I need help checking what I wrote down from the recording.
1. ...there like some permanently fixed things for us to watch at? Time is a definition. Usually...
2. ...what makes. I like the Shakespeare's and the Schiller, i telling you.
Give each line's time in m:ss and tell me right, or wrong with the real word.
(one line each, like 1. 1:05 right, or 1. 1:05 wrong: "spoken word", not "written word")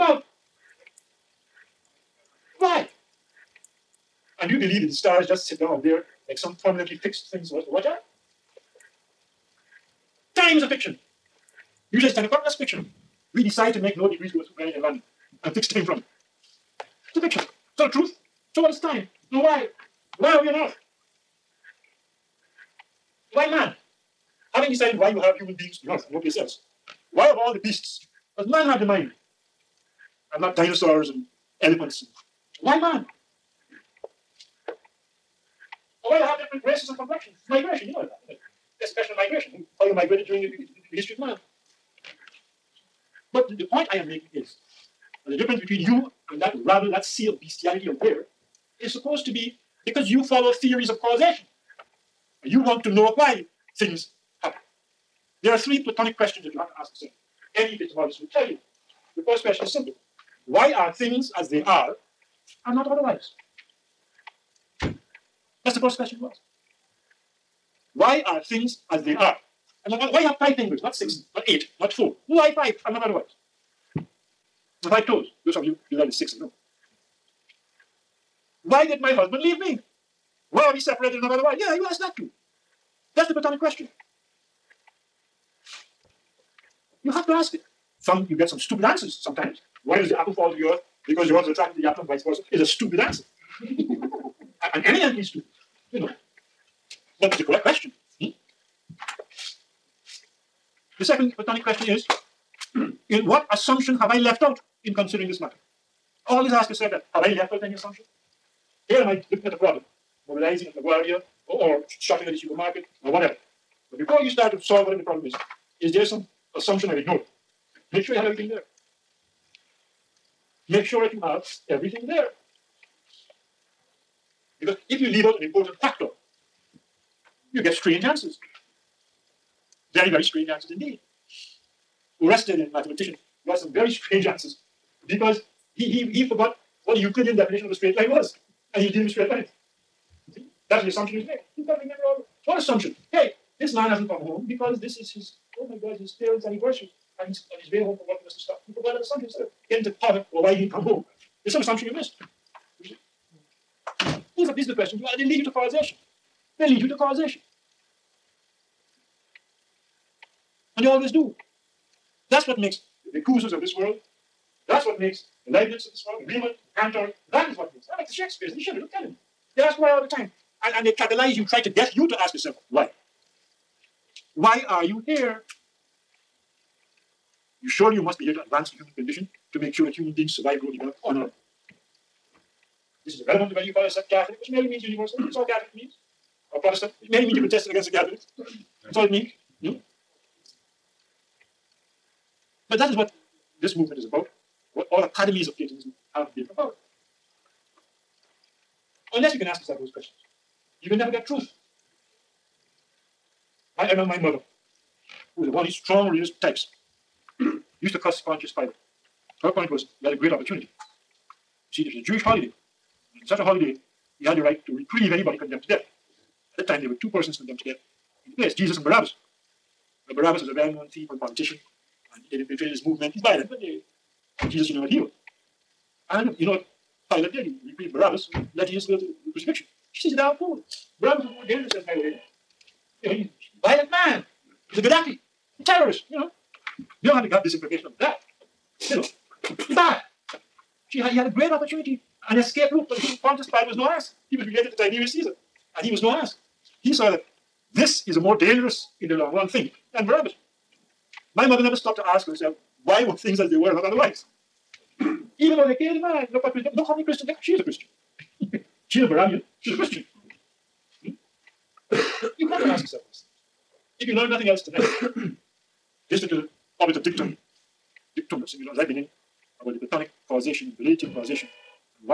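1. 0:05 wrong: "fiction", not "definition"
2. 2:47 right.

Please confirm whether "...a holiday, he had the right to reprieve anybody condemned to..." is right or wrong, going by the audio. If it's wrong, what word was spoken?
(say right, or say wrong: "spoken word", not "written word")
right.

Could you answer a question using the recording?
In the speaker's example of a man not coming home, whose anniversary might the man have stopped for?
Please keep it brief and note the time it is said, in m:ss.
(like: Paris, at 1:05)
His parents' anniversary, at 2:25.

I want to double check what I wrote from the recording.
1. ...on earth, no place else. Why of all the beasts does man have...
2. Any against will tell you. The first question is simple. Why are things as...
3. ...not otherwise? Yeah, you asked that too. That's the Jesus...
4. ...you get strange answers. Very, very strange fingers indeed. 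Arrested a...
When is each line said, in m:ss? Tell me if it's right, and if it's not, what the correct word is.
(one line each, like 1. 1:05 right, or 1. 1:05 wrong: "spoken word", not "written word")
1. 0:25 right
2. 0:57 wrong: "epistemologist", not "against"
3. 1:21 wrong: "Platonic", not "Jesus"
4. 2:07 wrong: "answers", not "fingers".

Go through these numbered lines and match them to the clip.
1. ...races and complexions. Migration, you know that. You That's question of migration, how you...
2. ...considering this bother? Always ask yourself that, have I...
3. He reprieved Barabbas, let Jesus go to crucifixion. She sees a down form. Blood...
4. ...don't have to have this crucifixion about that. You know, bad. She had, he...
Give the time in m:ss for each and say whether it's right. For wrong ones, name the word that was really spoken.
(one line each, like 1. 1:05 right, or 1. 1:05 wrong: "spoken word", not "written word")
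1. 0:36 right
2. 1:44 wrong: "matter", not "bother"
3. 3:47 right
4. 3:57 wrong: "information", not "crucifixion".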